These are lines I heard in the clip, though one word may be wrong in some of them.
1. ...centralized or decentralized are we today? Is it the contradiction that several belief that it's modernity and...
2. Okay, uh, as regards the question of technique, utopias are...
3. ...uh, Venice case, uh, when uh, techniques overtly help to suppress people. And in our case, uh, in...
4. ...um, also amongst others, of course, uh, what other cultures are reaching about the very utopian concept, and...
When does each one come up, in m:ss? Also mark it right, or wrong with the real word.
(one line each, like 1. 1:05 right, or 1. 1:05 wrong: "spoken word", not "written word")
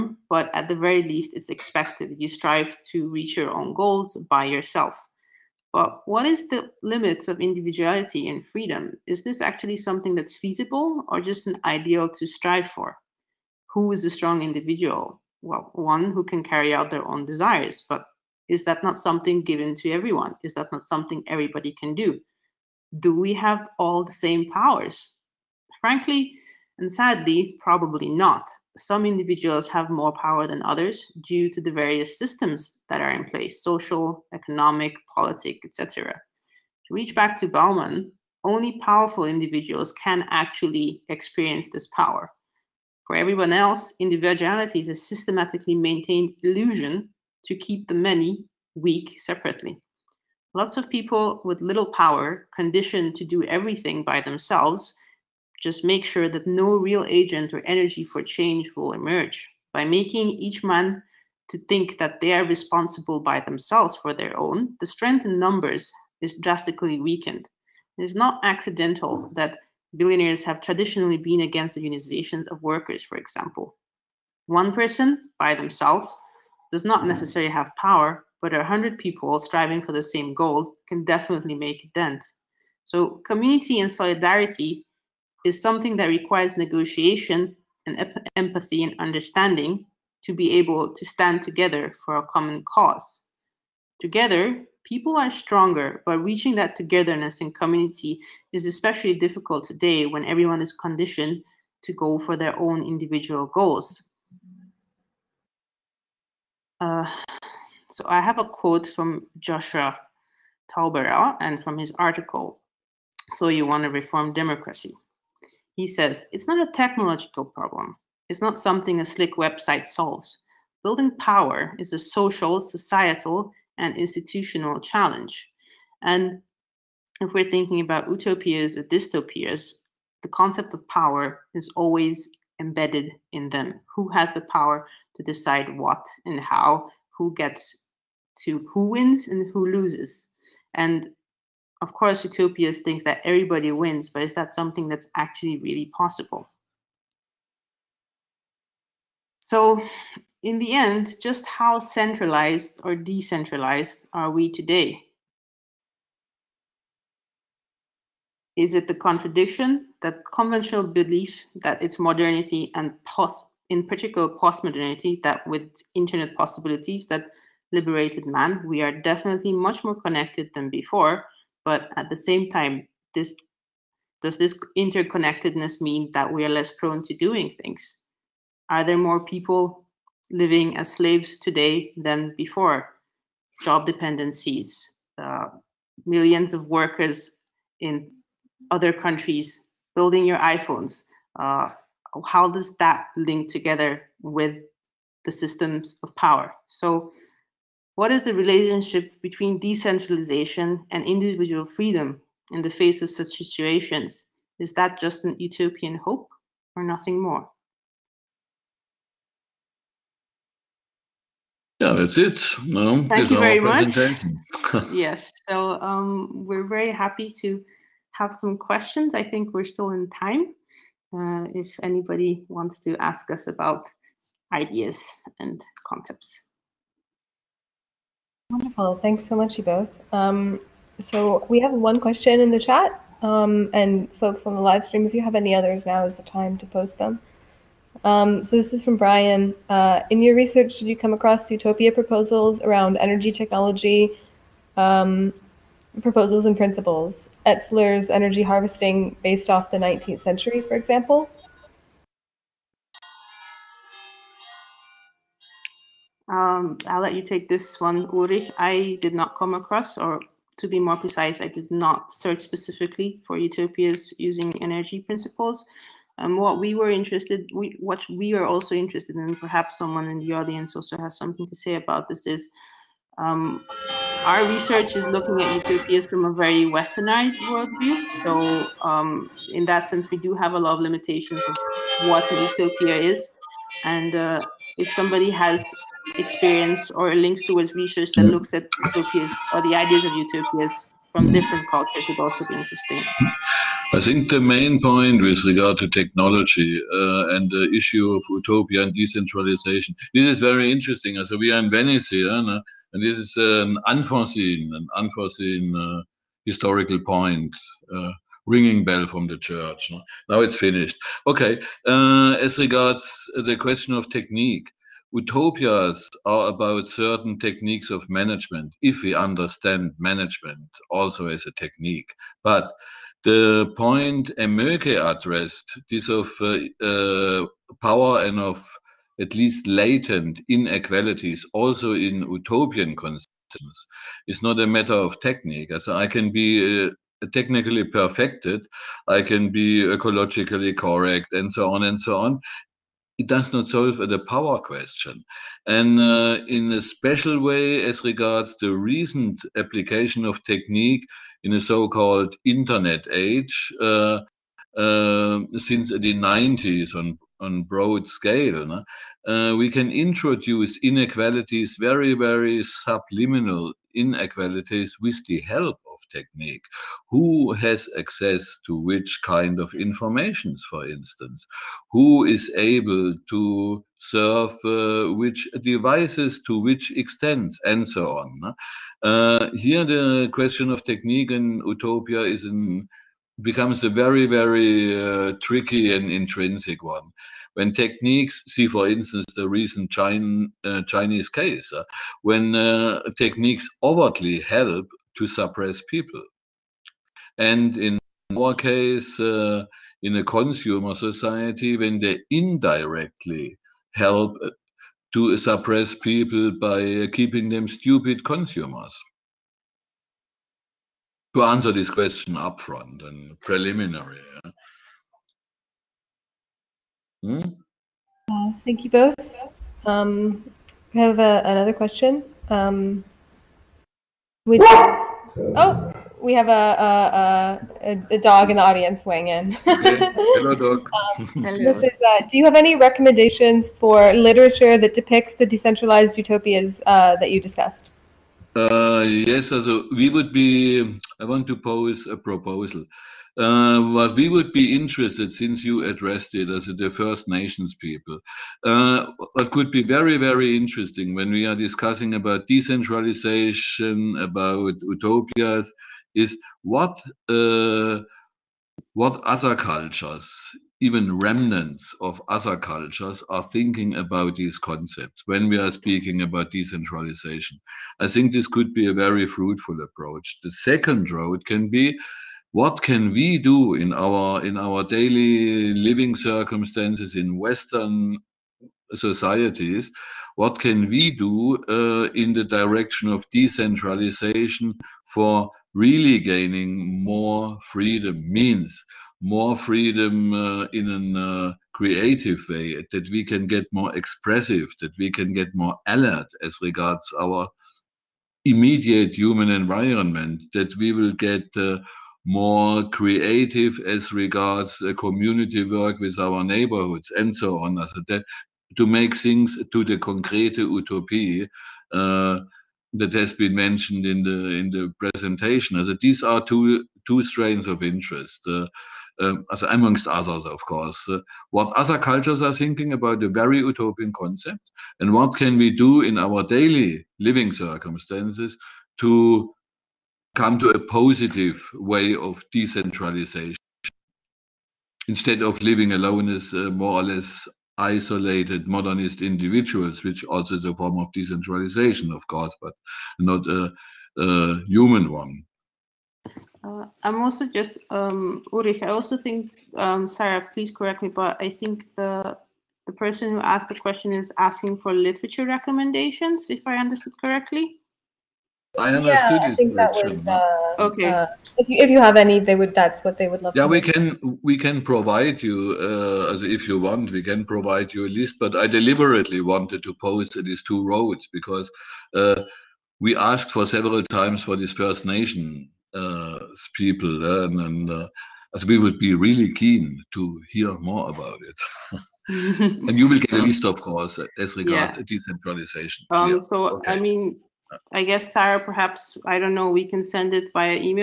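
1. 2:31 wrong: "conventional", not "several"
2. 5:11 right
3. 6:29 wrong: "Chinese", not "Venice"
4. 8:39 wrong: "thinking", not "reaching".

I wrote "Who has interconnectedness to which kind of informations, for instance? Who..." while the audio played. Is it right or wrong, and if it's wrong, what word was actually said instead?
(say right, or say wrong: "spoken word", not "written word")
wrong: "access", not "interconnectedness".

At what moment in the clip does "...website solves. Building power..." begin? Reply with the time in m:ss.
1:59.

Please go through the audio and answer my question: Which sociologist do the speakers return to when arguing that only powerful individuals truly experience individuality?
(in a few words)
Bauman.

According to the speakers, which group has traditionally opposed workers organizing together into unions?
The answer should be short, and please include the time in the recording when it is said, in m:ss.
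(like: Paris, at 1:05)
billionaires, at 1:09.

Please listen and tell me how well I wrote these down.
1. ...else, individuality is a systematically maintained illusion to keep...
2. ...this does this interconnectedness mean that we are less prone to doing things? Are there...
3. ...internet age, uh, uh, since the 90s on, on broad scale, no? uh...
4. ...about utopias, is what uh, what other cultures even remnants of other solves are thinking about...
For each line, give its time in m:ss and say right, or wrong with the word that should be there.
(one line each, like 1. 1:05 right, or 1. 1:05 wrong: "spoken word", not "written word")
1. 0:43 right
2. 2:53 right
3. 5:52 right
4. 7:34 wrong: "cultures", not "solves".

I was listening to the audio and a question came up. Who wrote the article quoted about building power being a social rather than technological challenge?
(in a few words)
Joshua Tauberer.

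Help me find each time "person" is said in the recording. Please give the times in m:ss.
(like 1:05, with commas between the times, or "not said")
1:14, 9:12.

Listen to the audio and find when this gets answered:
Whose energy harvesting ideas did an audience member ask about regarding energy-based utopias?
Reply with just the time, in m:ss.
4:07.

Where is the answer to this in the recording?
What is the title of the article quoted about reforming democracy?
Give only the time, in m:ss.
1:53.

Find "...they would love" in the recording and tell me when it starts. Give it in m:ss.
9:23.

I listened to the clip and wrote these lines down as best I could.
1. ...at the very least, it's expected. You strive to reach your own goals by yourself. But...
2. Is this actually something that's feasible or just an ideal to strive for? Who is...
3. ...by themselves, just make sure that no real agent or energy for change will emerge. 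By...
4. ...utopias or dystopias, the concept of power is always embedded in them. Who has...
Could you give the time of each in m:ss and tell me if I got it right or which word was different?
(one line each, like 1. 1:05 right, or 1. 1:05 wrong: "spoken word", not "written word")
1. 0:00 right
2. 0:09 right
3. 0:54 right
4. 2:08 right.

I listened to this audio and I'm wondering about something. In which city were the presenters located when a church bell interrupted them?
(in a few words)
Venice.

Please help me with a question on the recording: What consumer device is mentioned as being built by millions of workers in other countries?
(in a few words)
iPhones.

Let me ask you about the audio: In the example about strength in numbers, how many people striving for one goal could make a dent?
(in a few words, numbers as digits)
100.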